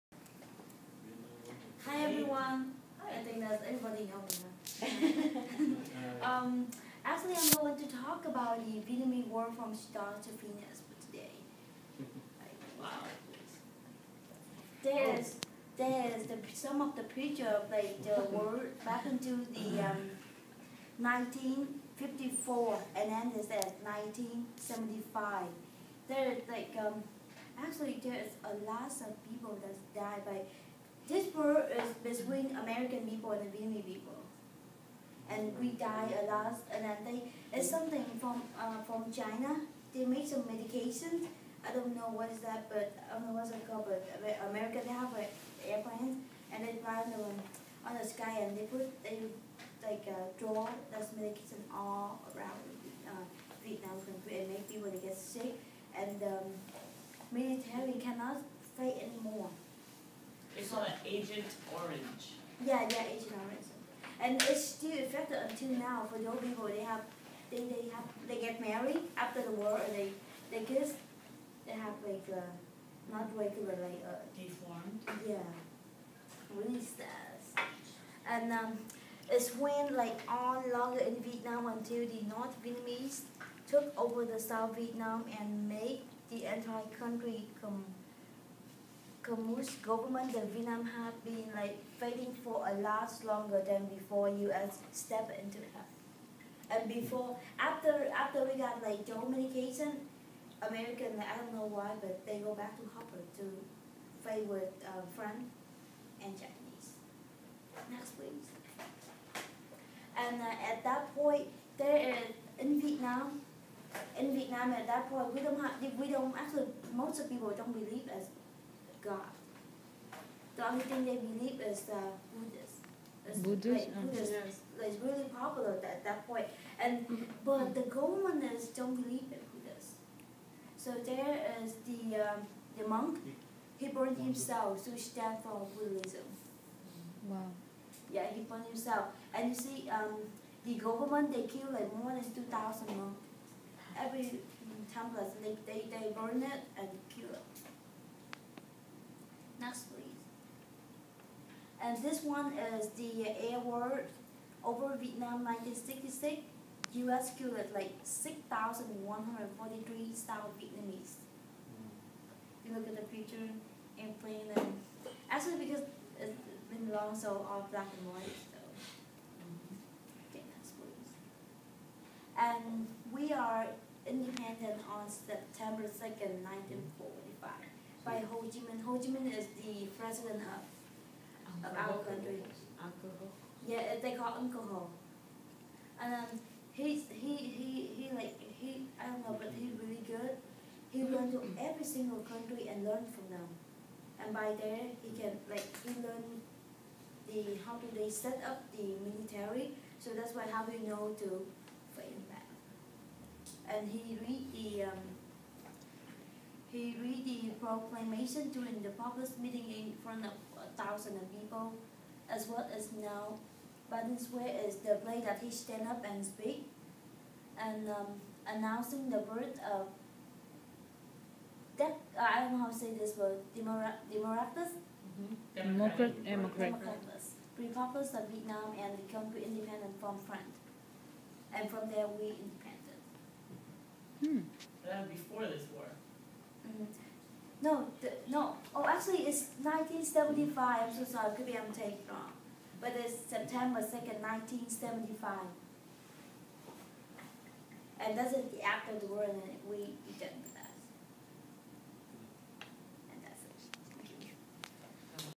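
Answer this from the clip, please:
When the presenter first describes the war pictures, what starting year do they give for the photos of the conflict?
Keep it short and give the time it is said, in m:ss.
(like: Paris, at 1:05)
1954, at 0:20.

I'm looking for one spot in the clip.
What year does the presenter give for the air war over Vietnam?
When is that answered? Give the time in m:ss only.
2:35.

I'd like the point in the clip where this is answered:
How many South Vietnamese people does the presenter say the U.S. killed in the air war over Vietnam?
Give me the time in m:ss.
2:38.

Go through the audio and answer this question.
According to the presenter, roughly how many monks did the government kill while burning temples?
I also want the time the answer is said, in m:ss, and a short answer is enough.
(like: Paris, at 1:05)
more than 2,000, at 2:21.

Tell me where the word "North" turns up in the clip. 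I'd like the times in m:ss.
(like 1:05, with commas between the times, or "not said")
1:22.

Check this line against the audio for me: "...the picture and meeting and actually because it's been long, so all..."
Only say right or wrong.
wrong.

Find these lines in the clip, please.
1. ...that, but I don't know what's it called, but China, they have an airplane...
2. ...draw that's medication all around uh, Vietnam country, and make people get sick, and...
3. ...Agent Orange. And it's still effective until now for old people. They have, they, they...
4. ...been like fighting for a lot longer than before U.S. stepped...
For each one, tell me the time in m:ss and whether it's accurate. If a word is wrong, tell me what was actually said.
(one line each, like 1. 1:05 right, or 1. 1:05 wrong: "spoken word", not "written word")
1. 0:42 wrong: "America", not "China"
2. 0:50 right
3. 1:03 right
4. 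1:31 right.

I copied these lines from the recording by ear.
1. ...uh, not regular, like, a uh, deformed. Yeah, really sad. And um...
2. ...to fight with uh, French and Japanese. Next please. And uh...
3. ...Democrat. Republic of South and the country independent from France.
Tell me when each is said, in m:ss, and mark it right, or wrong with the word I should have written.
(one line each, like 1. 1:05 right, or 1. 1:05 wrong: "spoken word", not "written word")
1. 1:12 right
2. 1:43 right
3. 3:46 wrong: "Vietnam", not "South".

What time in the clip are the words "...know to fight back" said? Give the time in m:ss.
3:20.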